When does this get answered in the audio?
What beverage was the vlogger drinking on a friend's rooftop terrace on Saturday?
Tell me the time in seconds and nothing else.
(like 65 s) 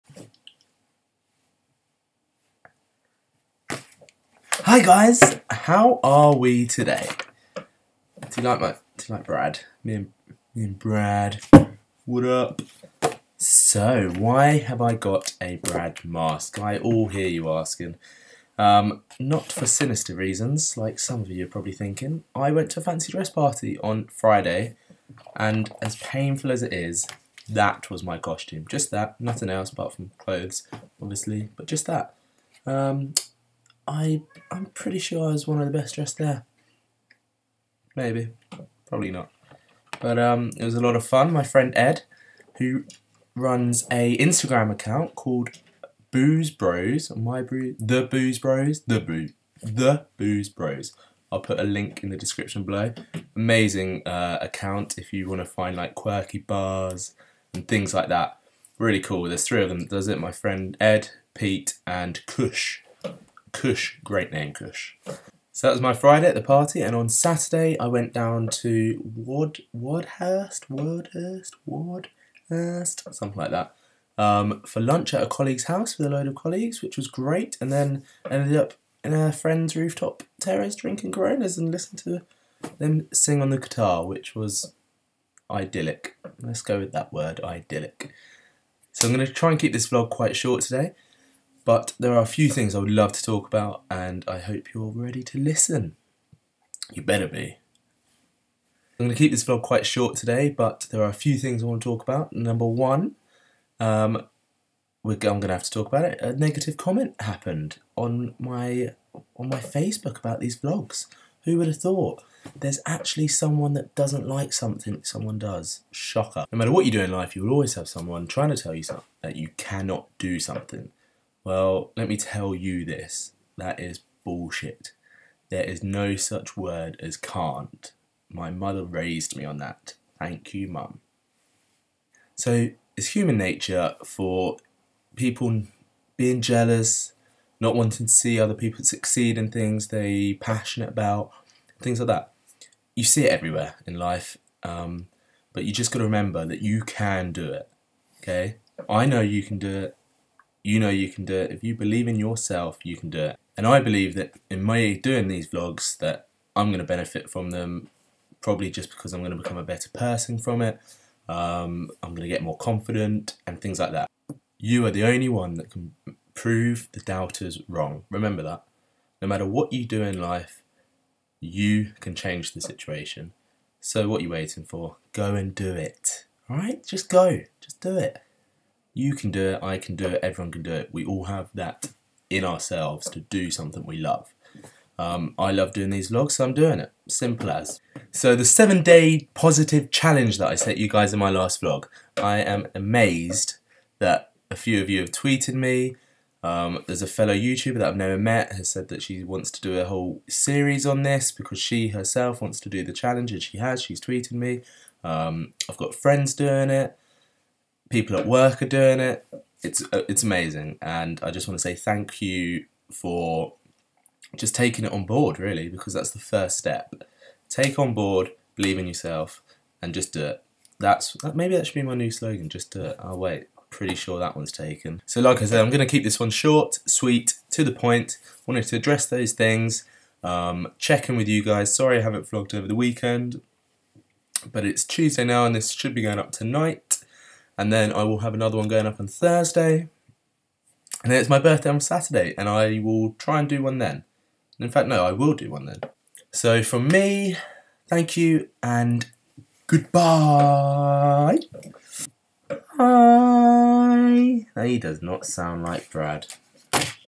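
81 s.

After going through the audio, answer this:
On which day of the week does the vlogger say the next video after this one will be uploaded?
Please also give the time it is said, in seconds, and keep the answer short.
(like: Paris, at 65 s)
Thursday, at 239 s.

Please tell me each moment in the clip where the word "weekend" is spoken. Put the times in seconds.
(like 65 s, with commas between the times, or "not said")
232 s.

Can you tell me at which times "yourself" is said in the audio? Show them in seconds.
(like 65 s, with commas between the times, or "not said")
152 s, 218 s.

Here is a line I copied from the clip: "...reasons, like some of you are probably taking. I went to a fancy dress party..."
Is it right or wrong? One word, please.
wrong.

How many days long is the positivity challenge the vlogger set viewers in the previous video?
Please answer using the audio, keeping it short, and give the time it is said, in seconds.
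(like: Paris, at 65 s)
7, at 188 s.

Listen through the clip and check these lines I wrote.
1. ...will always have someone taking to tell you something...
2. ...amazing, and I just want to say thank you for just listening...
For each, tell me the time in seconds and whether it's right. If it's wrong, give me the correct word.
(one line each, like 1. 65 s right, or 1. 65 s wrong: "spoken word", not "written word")
1. 117 s wrong: "trying", not "taking"
2. 210 s wrong: "taking", not "listening".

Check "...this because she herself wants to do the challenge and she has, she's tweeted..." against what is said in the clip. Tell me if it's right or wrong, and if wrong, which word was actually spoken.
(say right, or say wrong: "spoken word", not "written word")
right.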